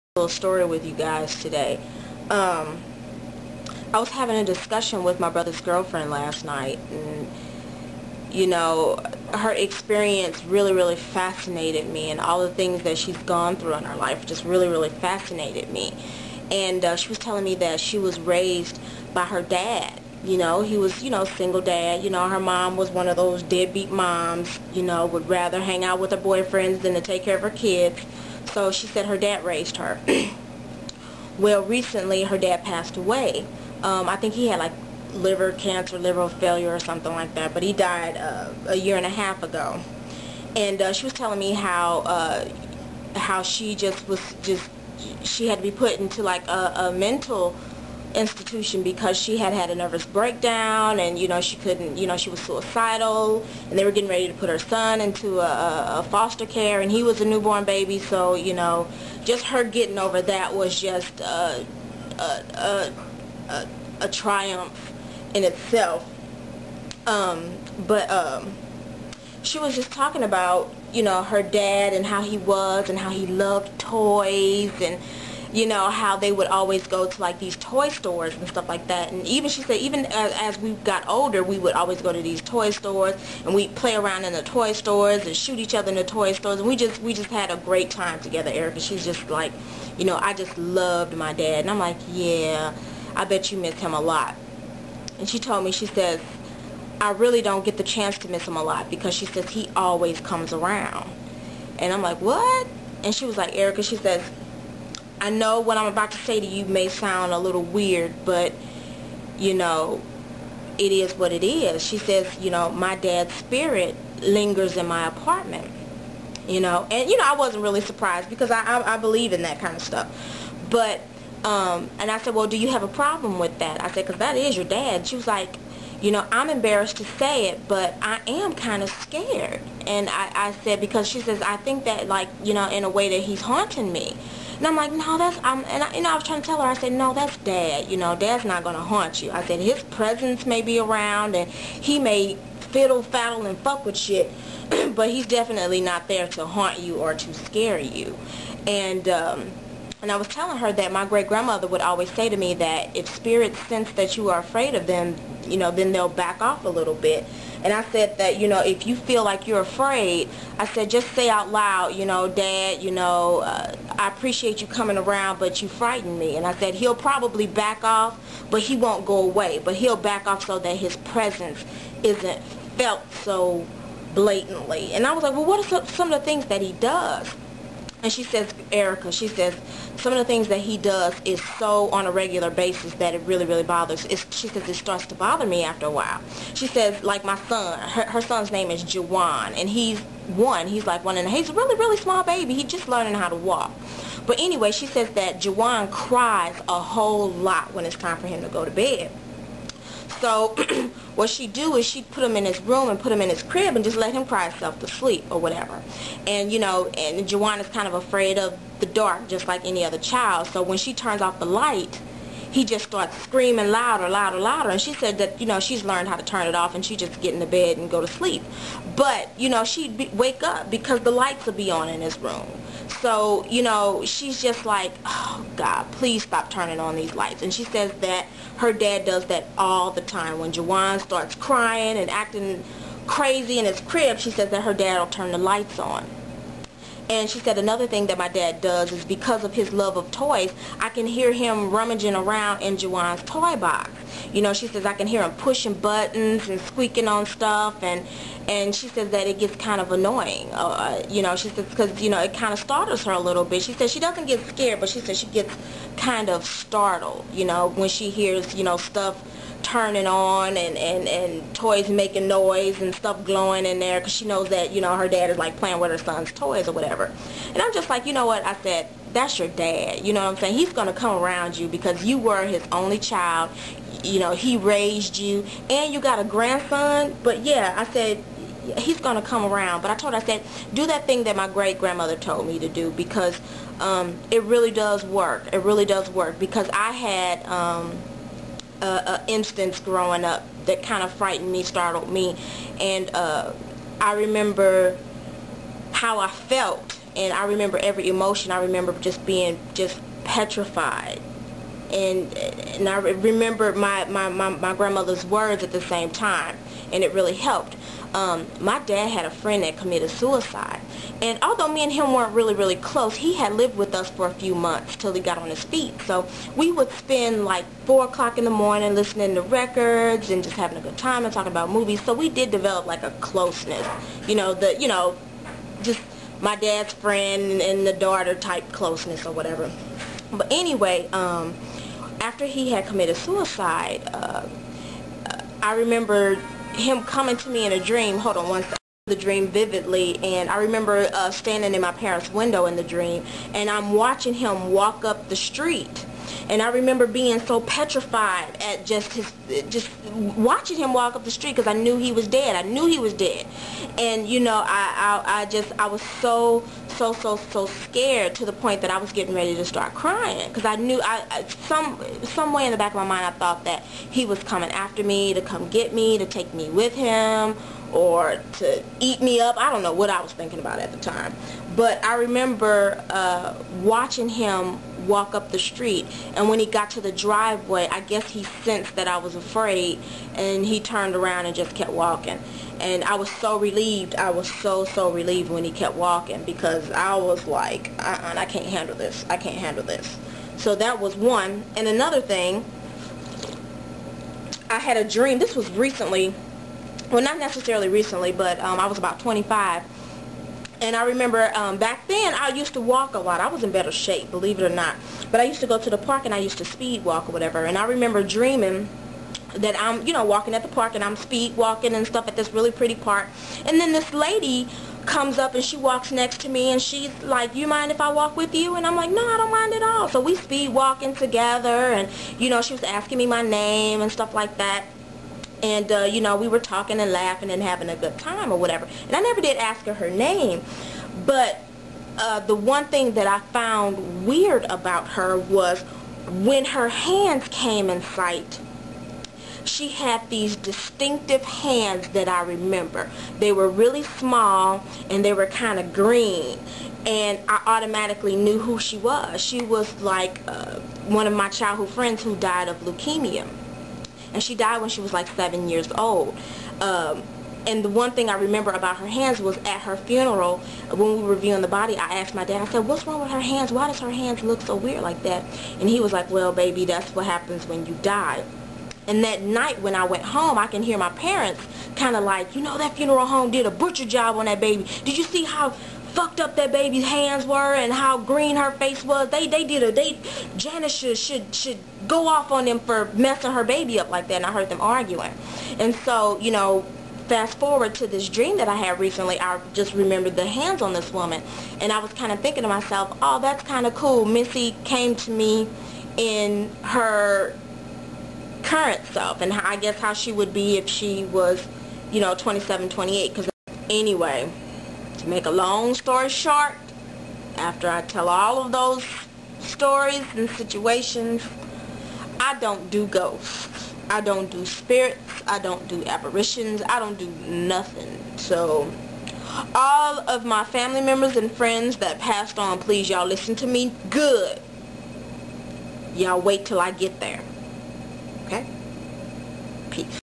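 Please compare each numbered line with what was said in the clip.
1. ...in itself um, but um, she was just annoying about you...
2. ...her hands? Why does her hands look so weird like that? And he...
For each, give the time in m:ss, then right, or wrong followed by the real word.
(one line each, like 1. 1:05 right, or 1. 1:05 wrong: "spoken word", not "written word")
1. 1:05 wrong: "talking", not "annoying"
2. 7:43 right.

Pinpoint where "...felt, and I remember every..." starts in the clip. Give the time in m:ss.
4:56.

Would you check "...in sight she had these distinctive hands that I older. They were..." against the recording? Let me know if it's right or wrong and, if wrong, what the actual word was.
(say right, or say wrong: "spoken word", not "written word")
wrong: "remember", not "older".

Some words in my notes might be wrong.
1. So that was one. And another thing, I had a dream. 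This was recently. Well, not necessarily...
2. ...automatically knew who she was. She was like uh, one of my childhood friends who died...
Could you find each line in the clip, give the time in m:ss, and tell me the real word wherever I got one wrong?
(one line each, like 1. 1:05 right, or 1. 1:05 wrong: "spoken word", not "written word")
1. 6:30 right
2. 7:27 right.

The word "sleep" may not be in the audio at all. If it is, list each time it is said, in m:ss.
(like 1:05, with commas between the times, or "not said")
3:24, 3:38.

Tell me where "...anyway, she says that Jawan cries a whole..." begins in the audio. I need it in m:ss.
3:14.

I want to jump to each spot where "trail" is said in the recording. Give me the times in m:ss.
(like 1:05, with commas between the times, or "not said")
not said.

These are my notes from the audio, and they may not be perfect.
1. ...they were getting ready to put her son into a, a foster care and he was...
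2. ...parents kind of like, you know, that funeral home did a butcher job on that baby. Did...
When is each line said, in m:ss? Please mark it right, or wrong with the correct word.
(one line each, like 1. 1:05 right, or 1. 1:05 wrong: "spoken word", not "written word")
1. 0:53 right
2. 7:51 right.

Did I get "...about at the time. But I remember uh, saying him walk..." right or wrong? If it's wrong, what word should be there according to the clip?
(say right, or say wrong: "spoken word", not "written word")
wrong: "watching", not "saying".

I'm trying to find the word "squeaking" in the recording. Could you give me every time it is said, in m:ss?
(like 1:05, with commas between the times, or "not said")
4:06.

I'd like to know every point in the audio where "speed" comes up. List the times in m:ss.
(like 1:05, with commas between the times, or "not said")
6:46, 6:51, 7:00.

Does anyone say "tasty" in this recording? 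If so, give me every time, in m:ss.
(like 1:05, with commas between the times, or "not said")
not said.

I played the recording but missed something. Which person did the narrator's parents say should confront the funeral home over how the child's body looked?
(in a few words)
Janice.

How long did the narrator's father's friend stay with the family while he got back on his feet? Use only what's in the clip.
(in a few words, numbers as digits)
A few months.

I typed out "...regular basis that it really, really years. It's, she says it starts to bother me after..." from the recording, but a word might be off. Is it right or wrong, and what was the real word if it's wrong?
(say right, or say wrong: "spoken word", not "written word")
wrong: "bothers", not "years".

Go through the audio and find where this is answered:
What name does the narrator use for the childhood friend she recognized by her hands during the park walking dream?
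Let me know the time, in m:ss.
8:14.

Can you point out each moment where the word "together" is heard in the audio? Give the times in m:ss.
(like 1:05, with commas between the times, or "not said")
1:28, 7:01.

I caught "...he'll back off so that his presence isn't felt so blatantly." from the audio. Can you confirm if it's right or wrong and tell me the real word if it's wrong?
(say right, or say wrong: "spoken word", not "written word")
right.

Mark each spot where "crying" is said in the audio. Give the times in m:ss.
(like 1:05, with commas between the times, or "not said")
3:51, 5:59.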